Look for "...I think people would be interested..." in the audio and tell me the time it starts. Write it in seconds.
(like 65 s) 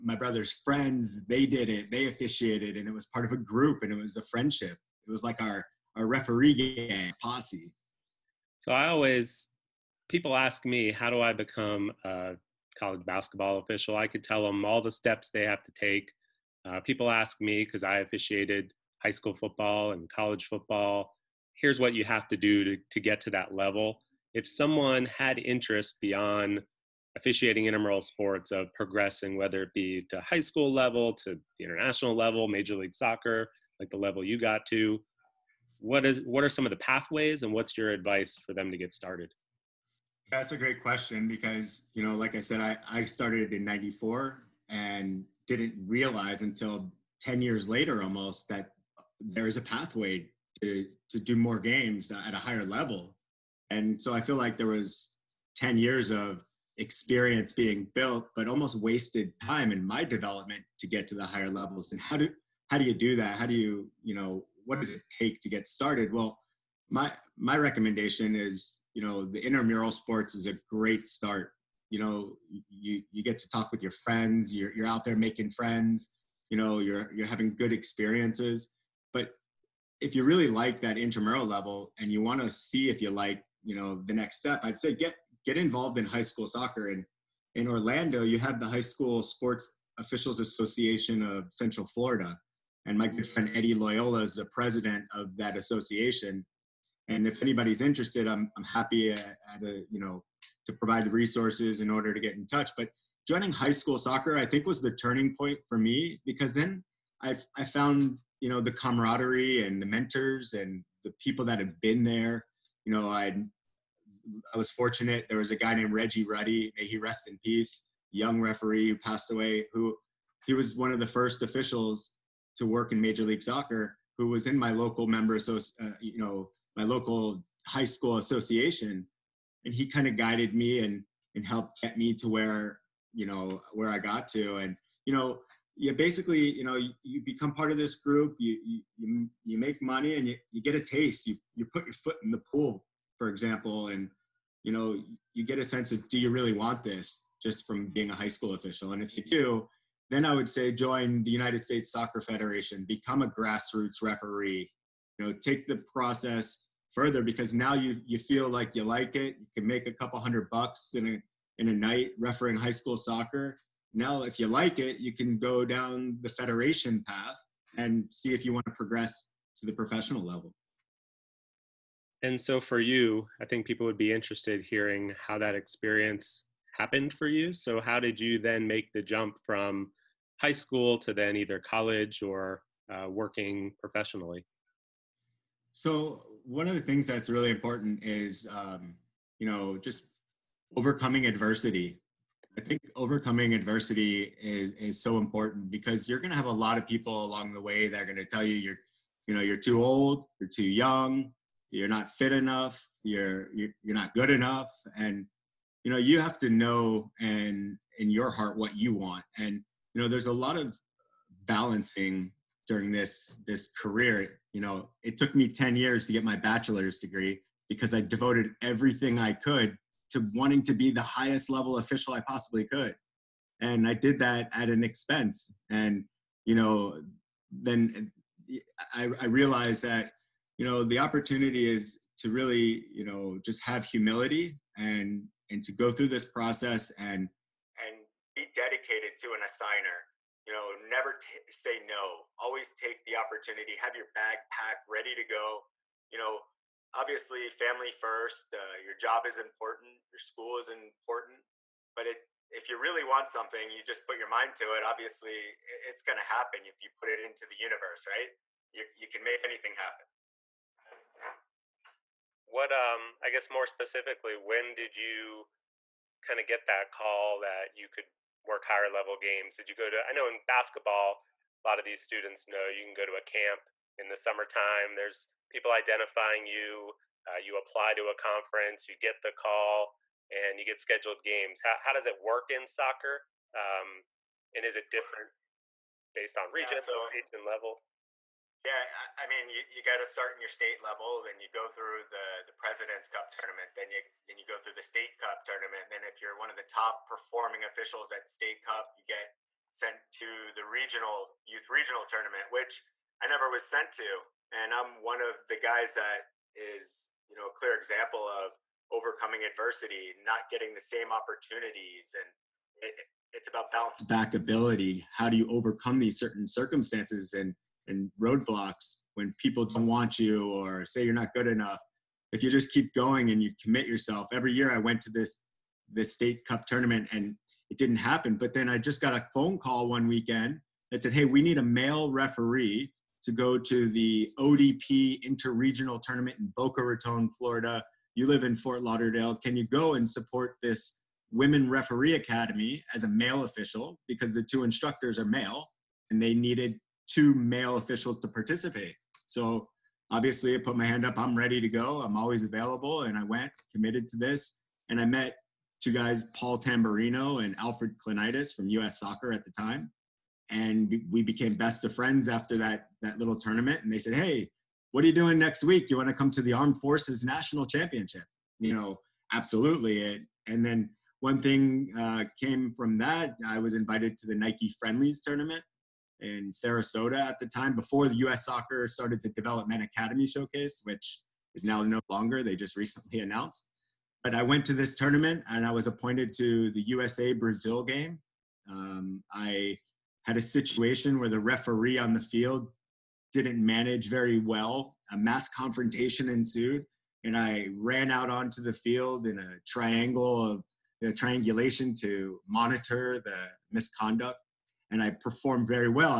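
173 s.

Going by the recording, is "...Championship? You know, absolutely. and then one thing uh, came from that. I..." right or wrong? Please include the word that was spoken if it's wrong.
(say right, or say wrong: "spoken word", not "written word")
right.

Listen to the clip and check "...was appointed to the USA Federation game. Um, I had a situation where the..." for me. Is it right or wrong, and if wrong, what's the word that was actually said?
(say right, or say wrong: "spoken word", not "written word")
wrong: "Brazil", not "Federation".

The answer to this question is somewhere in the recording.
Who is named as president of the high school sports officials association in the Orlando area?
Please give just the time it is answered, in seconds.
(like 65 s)
93 s.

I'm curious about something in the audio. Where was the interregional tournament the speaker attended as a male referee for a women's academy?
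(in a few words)
Boca Raton.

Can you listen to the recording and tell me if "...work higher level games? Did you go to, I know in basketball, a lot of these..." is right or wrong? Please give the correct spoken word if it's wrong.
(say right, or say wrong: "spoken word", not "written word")
right.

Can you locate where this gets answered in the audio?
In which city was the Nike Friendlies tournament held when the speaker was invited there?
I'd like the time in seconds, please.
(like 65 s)
376 s.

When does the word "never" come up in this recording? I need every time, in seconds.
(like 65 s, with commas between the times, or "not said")
240 s, 303 s.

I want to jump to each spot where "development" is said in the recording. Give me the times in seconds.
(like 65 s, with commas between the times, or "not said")
60 s, 379 s.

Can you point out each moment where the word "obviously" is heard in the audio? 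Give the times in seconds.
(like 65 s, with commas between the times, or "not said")
246 s, 254 s, 350 s.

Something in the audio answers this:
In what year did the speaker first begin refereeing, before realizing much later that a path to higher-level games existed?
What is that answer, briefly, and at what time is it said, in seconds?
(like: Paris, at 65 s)
1994, at 43 s.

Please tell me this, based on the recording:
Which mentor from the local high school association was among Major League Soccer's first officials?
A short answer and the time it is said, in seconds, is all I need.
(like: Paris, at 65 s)
Reggie Ruddy, at 115 s.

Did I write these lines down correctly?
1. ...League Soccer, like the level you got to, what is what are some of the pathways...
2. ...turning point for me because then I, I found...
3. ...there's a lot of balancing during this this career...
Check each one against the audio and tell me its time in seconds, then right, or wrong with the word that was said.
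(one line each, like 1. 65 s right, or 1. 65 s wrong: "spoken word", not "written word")
1. 32 s right
2. 104 s right
3. 210 s right.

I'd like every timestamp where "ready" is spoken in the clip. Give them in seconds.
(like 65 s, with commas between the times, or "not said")
244 s, 351 s.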